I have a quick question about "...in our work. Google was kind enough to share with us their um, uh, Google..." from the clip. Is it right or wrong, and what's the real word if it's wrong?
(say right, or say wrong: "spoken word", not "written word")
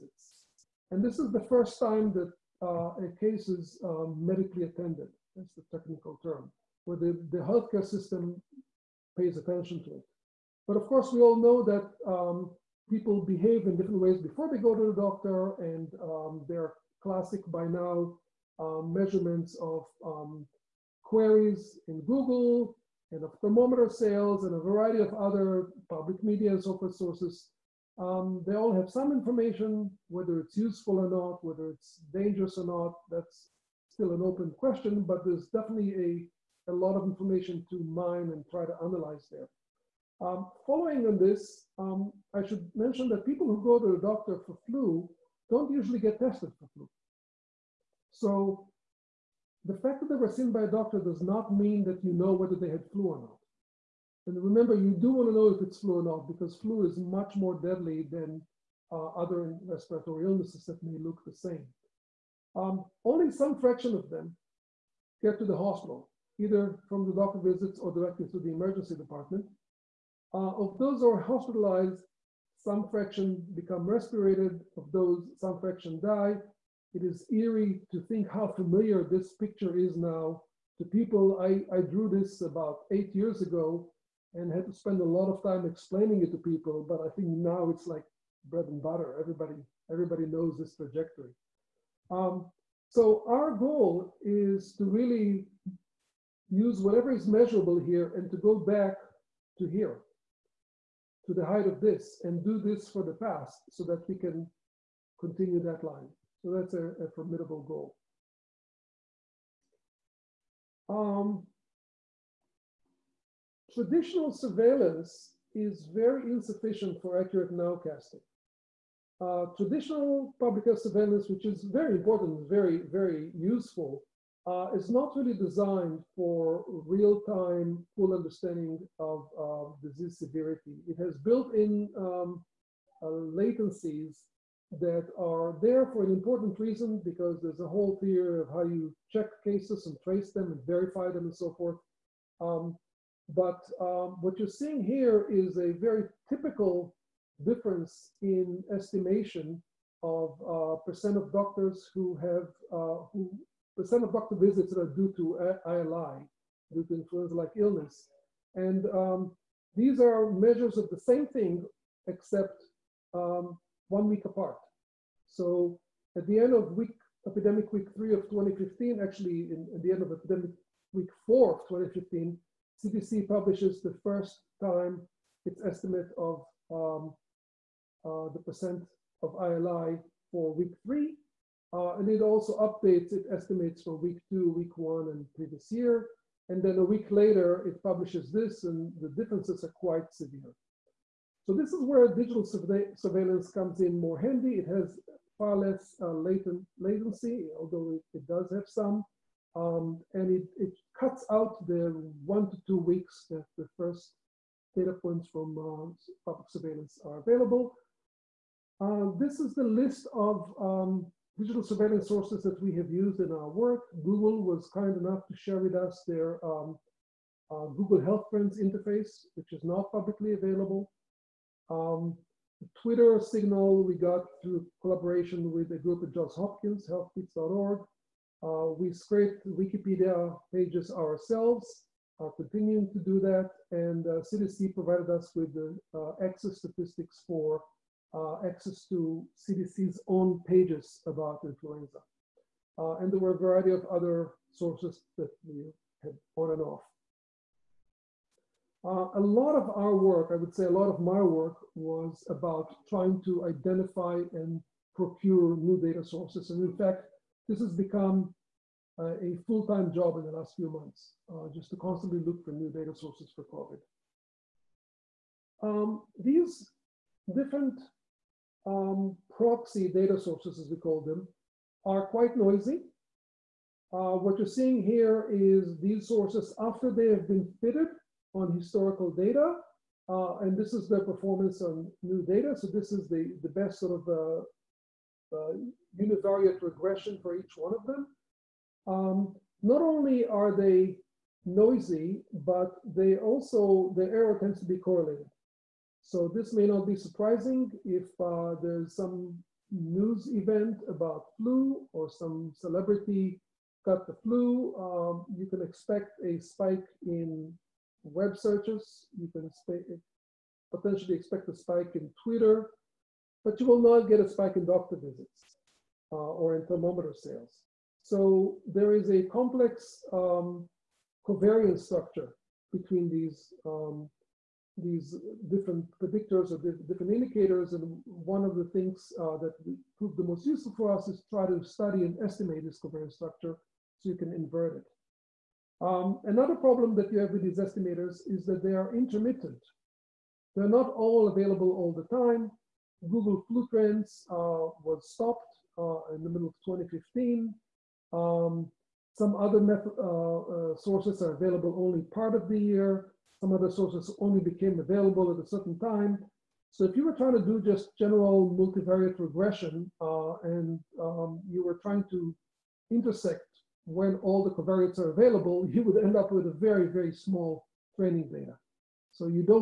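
right.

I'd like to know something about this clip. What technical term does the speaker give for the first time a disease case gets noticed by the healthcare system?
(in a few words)
medically attended.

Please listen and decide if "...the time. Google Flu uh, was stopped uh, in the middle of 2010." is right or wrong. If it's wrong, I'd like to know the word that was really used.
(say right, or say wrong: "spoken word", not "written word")
wrong: "2015", not "2010".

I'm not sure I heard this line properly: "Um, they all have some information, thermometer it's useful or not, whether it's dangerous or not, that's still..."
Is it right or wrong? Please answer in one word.
wrong.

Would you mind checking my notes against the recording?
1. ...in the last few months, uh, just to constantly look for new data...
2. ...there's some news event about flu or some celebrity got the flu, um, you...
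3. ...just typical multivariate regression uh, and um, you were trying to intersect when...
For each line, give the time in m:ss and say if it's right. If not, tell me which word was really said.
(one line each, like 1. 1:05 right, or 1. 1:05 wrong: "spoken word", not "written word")
1. 4:20 right
2. 4:58 right
3. 5:57 wrong: "general", not "typical".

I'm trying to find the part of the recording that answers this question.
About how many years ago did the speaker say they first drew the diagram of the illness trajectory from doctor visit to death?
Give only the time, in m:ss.
1:22.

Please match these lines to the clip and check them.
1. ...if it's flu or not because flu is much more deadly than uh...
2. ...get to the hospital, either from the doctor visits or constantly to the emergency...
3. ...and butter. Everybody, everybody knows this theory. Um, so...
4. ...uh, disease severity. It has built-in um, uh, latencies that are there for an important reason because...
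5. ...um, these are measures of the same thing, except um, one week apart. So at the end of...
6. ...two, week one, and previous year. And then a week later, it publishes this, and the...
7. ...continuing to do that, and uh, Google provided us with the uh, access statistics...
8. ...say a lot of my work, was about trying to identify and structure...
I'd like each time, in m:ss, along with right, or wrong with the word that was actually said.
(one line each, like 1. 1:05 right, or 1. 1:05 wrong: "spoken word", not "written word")
1. 0:55 right
2. 1:05 wrong: "directly", not "constantly"
3. 1:28 wrong: "trajectory", not "theory"
4. 2:09 right
5. 2:38 right
6. 3:04 right
7. 3:52 wrong: "CDC", not "Google"
8. 4:10 wrong: "procure", not "structure".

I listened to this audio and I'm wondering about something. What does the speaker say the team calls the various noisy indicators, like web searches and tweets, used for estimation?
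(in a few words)
proxy data sources.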